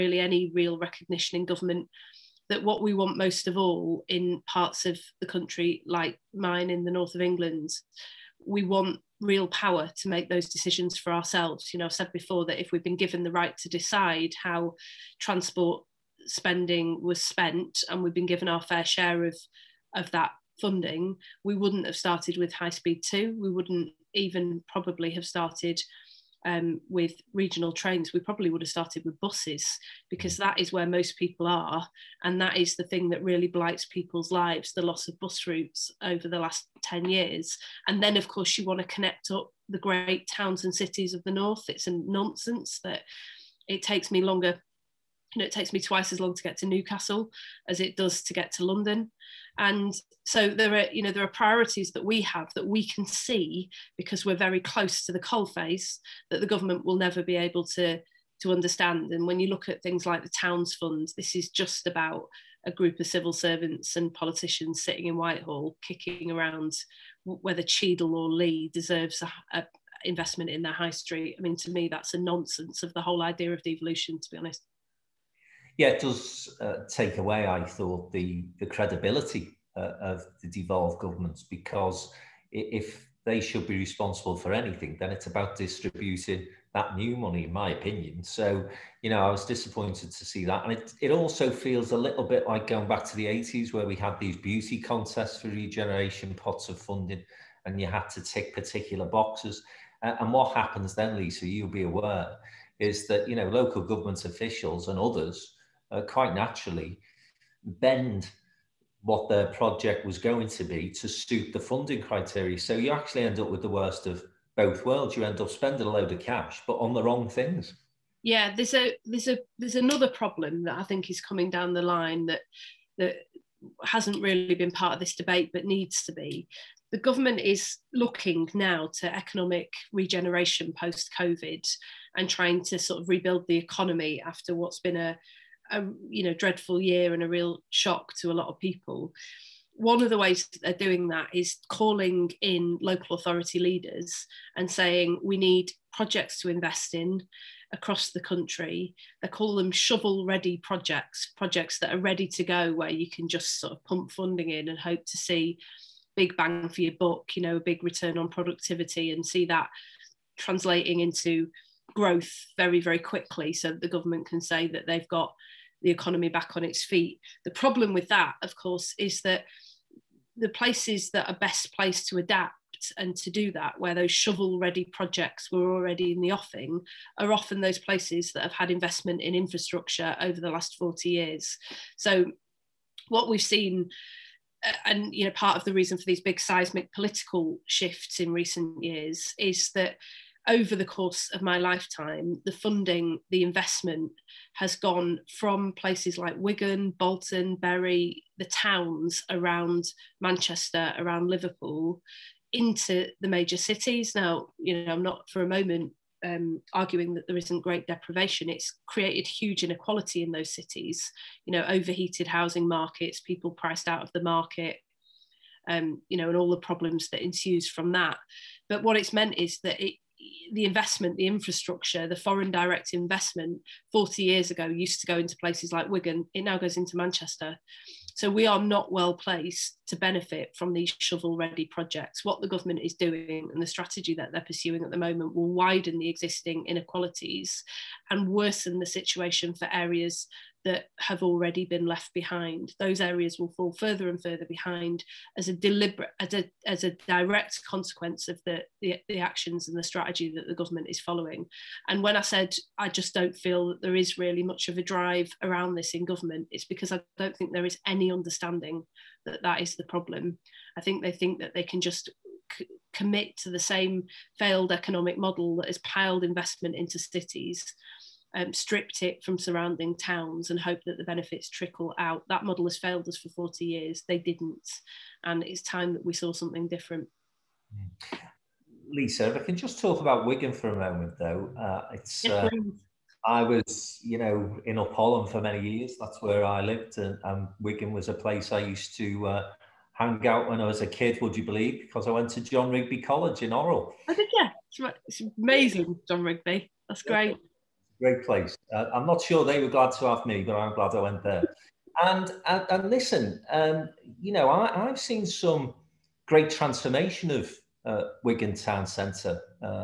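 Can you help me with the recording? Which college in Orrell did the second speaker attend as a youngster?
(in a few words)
John Rigby College.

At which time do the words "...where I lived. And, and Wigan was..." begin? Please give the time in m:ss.
4:46.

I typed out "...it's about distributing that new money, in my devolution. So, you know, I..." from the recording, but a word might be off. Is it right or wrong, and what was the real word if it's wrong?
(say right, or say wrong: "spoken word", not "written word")
wrong: "opinion", not "devolution".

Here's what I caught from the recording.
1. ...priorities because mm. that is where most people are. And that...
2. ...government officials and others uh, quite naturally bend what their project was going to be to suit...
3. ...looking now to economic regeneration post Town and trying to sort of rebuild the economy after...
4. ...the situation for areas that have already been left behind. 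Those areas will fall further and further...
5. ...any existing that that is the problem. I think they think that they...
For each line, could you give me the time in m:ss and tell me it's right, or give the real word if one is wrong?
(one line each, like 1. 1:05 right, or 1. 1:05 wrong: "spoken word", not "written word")
1. 0:29 wrong: "buses", not "priorities"
2. 1:43 right
3. 2:07 wrong: "COVID", not "Town"
4. 3:58 right
5. 4:17 wrong: "understanding", not "existing".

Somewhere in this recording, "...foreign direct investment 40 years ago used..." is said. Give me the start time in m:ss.
3:42.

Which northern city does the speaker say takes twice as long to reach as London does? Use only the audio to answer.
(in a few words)
Newcastle.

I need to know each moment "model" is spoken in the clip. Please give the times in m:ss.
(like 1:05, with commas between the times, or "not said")
4:25, 4:32.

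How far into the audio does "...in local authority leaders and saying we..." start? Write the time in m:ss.
2:22.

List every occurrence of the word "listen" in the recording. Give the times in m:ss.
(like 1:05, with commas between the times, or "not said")
5:02.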